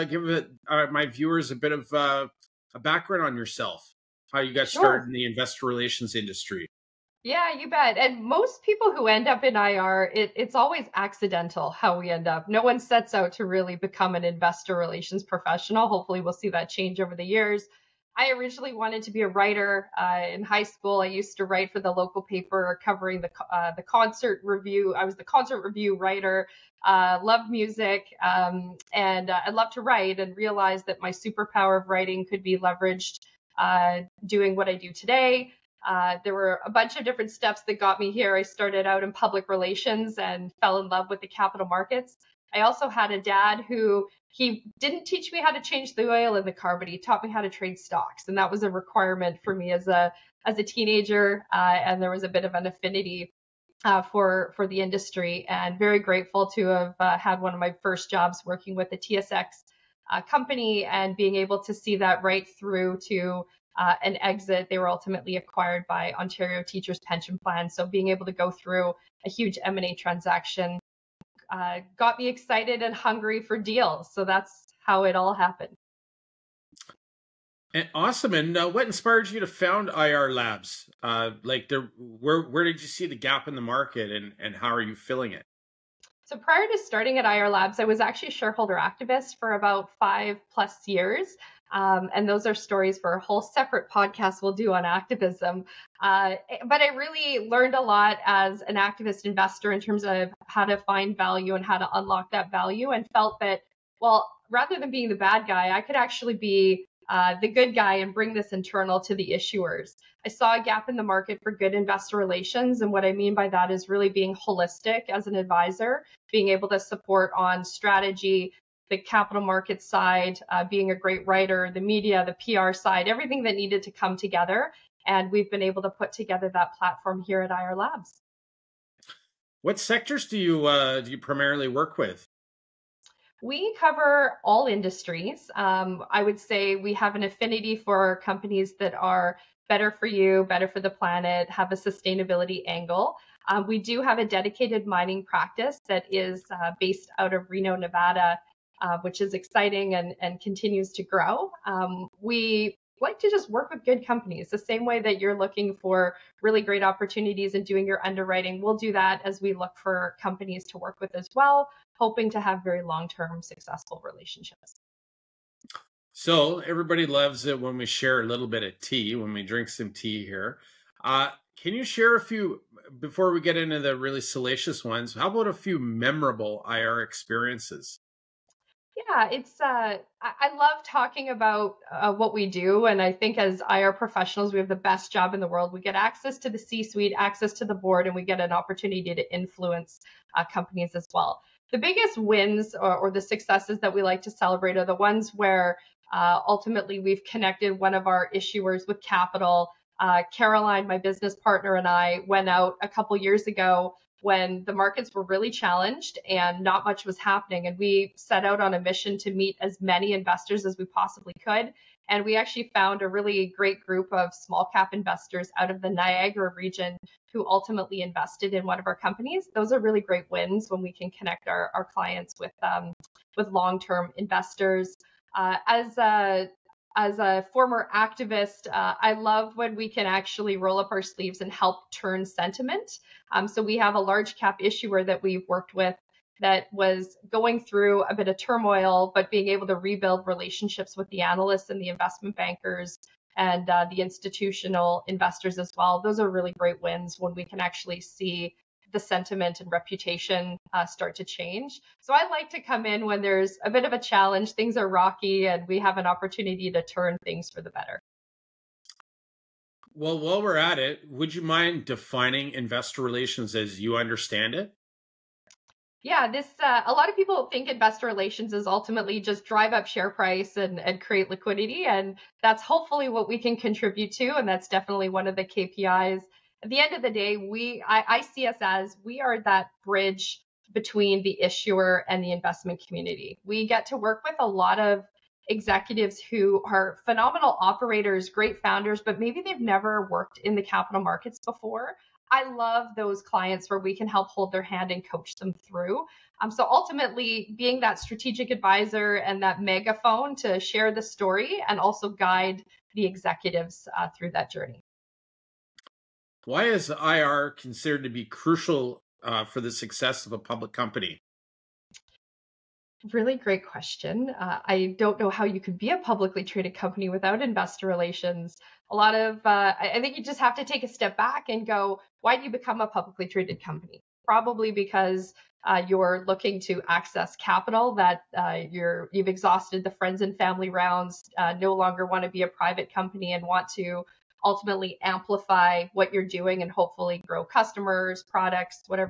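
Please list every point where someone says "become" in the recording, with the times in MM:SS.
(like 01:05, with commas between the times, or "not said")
00:13, 05:22.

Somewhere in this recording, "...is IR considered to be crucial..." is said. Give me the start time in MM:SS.
05:06.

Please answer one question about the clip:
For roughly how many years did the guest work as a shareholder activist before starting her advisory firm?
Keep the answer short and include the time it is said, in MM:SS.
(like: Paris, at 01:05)
5, at 01:30.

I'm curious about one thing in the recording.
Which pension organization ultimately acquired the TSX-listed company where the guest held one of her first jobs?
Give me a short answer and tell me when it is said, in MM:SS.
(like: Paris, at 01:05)
Ontario Teachers Pension Plan, at 01:06.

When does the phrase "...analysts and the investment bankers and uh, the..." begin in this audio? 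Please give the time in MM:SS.
04:01.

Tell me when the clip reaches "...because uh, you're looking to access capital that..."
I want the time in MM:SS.
05:24.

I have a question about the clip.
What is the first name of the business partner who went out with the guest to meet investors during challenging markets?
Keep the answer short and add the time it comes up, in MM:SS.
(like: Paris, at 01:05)
Caroline, at 03:20.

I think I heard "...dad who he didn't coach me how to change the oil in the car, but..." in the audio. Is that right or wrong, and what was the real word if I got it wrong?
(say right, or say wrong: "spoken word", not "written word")
wrong: "teach", not "coach".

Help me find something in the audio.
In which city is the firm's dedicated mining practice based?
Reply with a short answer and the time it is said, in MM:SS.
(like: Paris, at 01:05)
Reno, Nevada, at 02:27.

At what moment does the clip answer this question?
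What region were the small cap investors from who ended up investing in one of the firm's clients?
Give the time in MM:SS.
03:35.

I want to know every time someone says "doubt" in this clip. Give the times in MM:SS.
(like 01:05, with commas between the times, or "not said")
not said.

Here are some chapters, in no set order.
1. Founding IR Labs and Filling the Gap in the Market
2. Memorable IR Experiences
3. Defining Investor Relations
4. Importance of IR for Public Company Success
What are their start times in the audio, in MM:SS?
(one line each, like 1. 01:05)
1. 01:31
2. 02:58
3. 04:19
4. 05:12.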